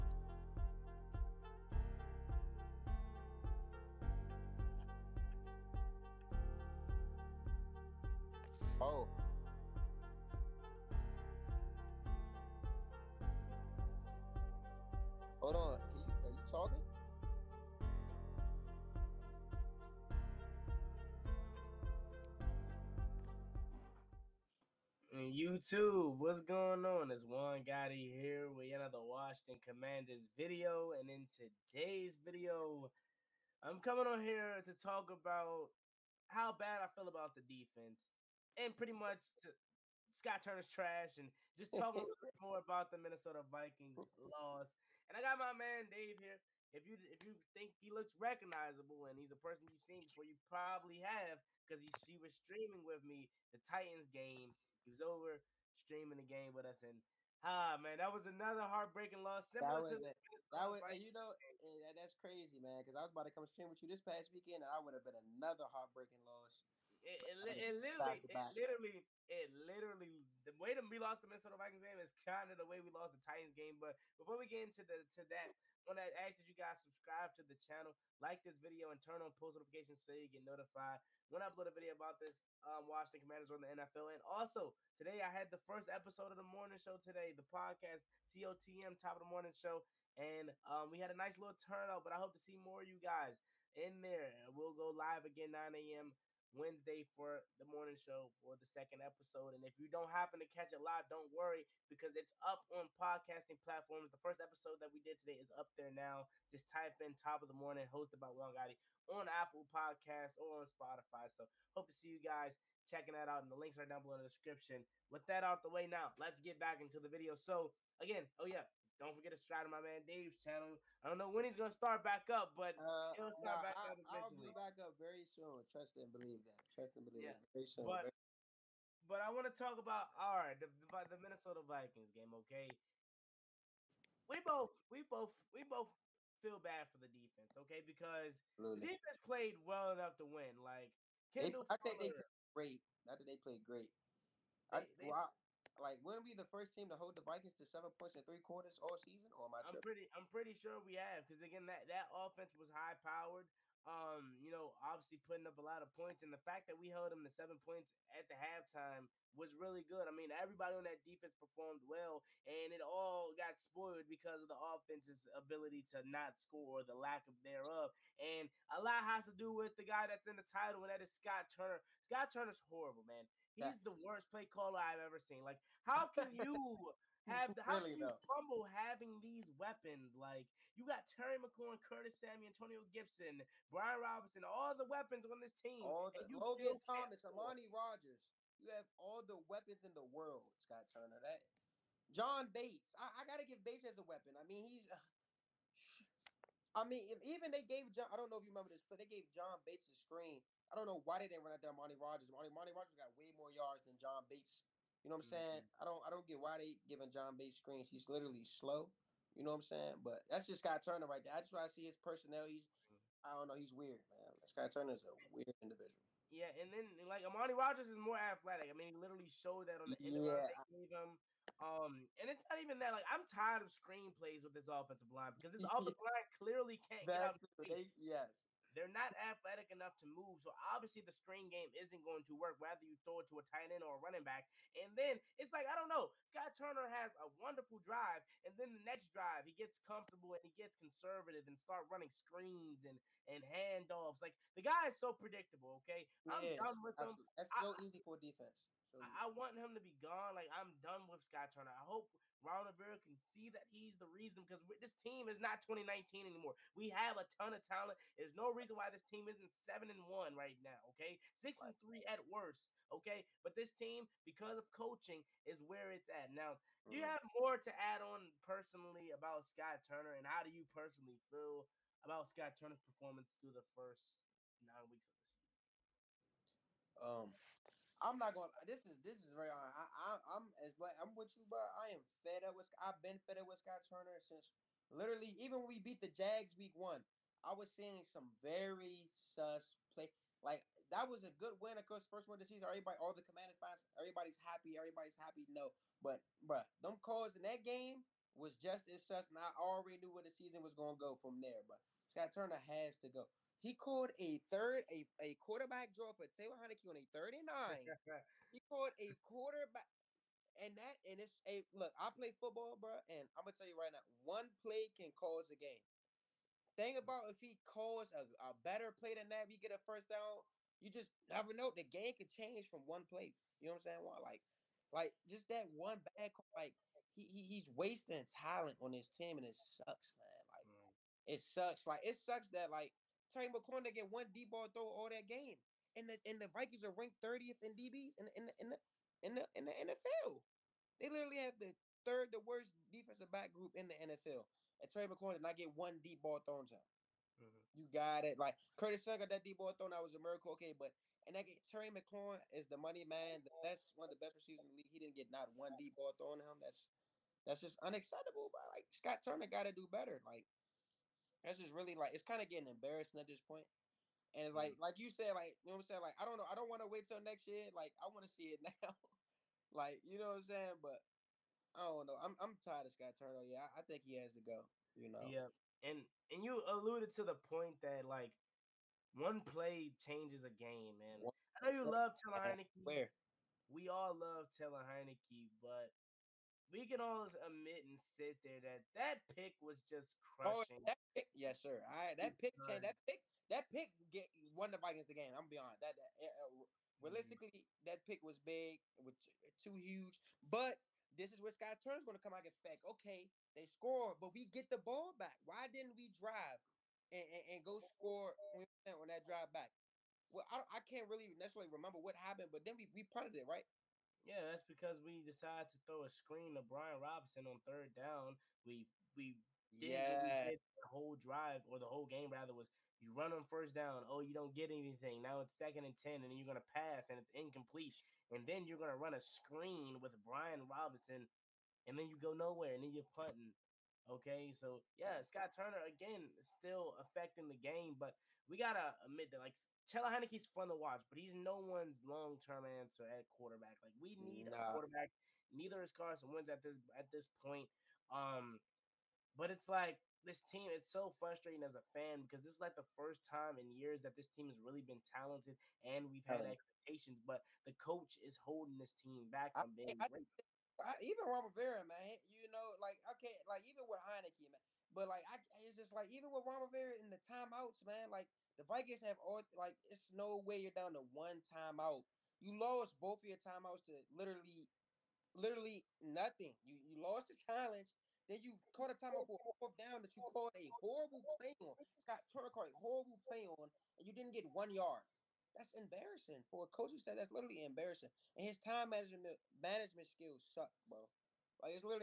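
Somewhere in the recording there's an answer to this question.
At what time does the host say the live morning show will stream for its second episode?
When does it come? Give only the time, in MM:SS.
01:35.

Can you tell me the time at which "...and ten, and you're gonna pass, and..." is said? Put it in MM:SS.
07:05.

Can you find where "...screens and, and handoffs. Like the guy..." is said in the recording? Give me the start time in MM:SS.
04:02.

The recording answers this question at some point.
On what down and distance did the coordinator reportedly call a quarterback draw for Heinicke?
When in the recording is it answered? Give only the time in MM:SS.
05:07.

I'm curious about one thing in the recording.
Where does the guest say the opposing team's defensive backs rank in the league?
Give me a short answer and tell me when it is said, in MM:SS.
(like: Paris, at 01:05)
30th, at 05:37.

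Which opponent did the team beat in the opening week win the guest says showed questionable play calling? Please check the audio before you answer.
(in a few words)
Jags.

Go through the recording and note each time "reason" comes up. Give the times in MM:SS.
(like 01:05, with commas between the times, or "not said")
04:14, 04:18.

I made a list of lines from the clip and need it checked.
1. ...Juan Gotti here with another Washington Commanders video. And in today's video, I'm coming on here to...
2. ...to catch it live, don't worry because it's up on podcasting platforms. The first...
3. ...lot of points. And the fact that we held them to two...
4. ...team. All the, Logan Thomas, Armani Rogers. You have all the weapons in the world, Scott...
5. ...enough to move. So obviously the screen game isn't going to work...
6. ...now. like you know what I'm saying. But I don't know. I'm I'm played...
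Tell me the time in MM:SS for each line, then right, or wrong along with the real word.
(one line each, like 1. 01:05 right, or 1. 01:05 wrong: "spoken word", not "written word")
1. 00:27 right
2. 01:40 right
3. 02:35 wrong: "seven", not "two"
4. 03:05 right
5. 03:49 right
6. 06:08 wrong: "tired", not "played".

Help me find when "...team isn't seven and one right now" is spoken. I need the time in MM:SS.
04:19.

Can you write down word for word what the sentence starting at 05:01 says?
But Scott Turner has to go.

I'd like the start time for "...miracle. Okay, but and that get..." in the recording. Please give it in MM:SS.
05:50.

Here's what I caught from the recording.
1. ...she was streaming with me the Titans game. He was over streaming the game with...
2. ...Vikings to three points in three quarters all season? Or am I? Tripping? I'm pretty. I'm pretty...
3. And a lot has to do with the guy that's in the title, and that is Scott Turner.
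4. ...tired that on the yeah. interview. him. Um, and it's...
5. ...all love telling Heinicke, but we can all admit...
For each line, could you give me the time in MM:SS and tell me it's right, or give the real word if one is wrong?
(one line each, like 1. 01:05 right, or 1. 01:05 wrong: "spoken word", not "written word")
1. 00:52 right
2. 02:27 wrong: "seven", not "three"
3. 02:48 right
4. 03:39 wrong: "showed", not "tired"
5. 06:23 right.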